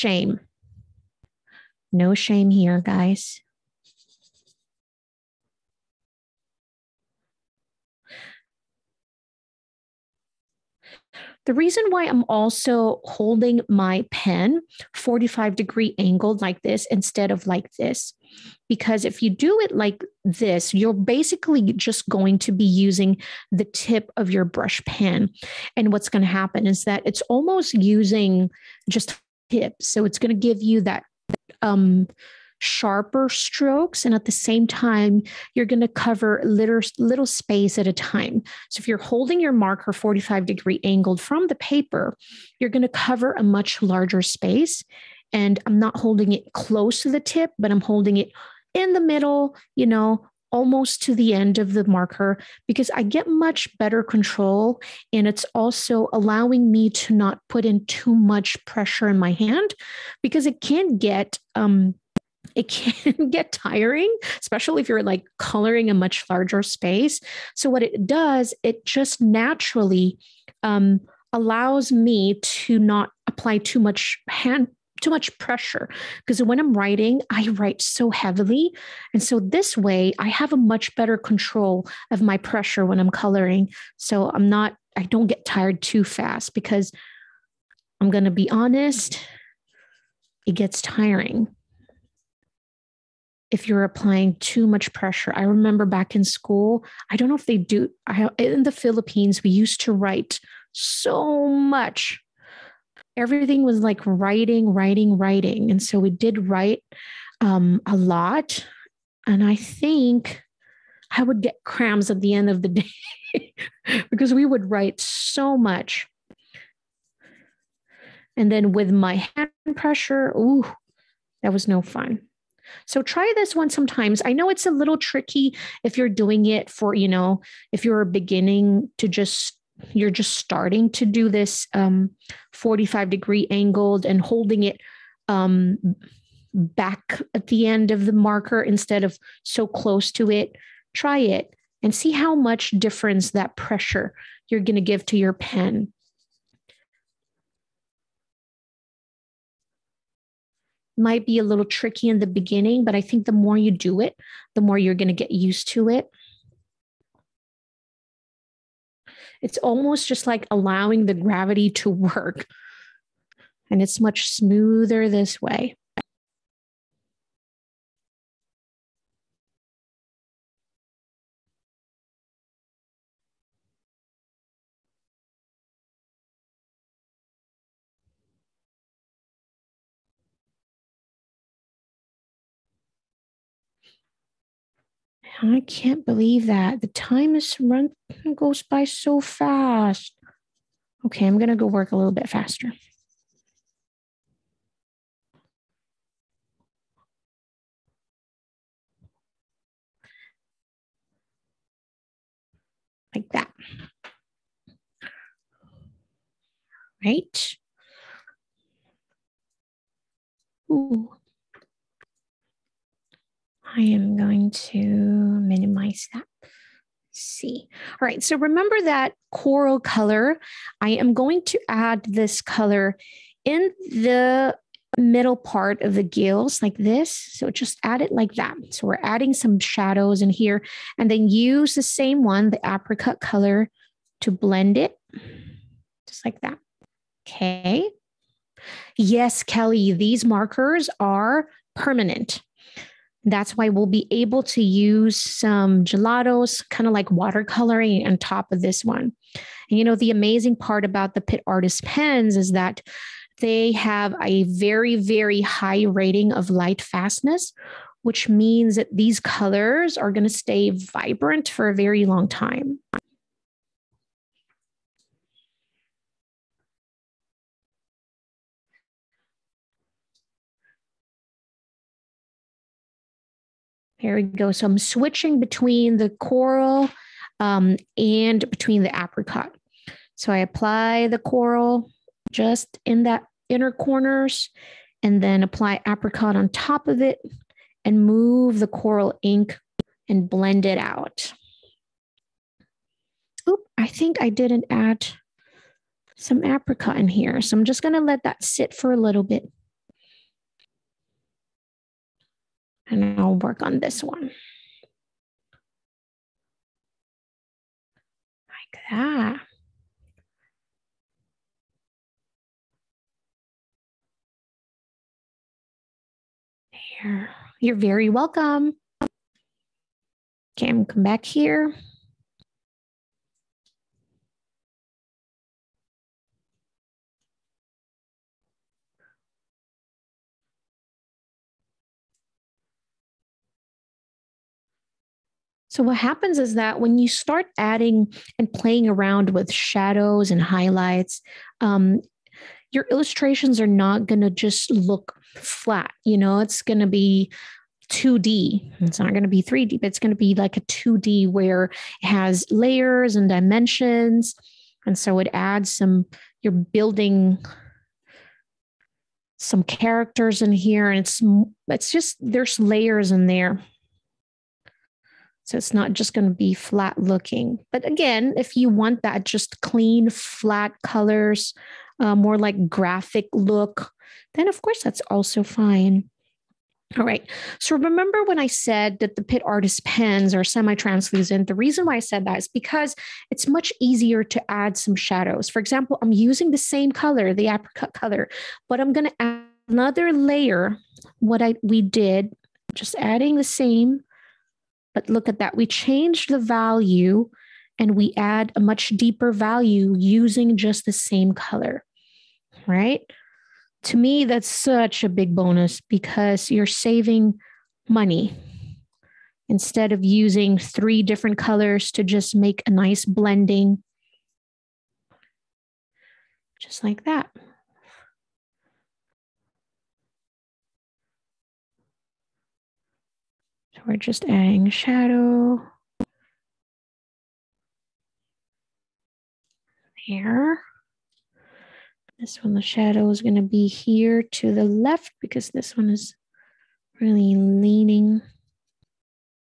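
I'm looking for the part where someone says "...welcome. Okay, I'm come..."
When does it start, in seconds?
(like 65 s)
318 s.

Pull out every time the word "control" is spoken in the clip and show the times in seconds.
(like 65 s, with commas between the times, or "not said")
54 s, 81 s.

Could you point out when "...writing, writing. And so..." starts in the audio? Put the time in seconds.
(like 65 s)
104 s.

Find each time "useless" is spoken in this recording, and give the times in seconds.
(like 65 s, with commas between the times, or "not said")
not said.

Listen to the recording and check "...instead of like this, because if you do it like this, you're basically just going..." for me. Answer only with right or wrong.
right.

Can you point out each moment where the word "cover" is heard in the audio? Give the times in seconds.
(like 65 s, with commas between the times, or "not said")
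35 s, 42 s.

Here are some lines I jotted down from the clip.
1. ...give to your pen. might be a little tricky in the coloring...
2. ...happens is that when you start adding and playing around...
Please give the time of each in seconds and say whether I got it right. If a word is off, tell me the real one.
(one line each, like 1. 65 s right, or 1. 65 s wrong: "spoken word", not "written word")
1. 144 s wrong: "beginning", not "coloring"
2. 335 s right.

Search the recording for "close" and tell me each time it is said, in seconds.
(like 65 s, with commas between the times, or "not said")
46 s, 139 s.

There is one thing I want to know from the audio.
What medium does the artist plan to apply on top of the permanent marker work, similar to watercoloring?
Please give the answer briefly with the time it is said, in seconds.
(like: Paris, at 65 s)
Gelatos, at 245 s.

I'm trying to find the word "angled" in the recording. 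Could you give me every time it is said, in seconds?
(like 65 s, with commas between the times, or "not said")
15 s, 40 s, 133 s.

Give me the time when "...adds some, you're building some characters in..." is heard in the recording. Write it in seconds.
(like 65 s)
355 s.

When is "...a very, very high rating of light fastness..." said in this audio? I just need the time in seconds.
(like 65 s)
254 s.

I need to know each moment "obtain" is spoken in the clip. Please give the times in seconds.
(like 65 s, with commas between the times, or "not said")
not said.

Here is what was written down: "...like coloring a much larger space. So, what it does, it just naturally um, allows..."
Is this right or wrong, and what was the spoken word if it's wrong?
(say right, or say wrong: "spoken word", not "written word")
right.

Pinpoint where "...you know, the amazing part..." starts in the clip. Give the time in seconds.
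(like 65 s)
249 s.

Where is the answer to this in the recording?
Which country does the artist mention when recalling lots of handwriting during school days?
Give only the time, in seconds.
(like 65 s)
98 s.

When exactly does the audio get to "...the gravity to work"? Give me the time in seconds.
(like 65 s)
161 s.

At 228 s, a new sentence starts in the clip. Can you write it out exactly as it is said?
So we're adding some shadows in here and then use the same one, the apricot color to blend it just like that.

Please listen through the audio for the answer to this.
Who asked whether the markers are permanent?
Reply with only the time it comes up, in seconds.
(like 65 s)
239 s.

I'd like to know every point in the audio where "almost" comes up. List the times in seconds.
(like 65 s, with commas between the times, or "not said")
27 s, 50 s, 159 s.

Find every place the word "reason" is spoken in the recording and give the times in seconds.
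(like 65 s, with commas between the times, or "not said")
11 s, 381 s.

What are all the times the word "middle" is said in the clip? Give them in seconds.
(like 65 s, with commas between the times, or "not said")
49 s, 224 s.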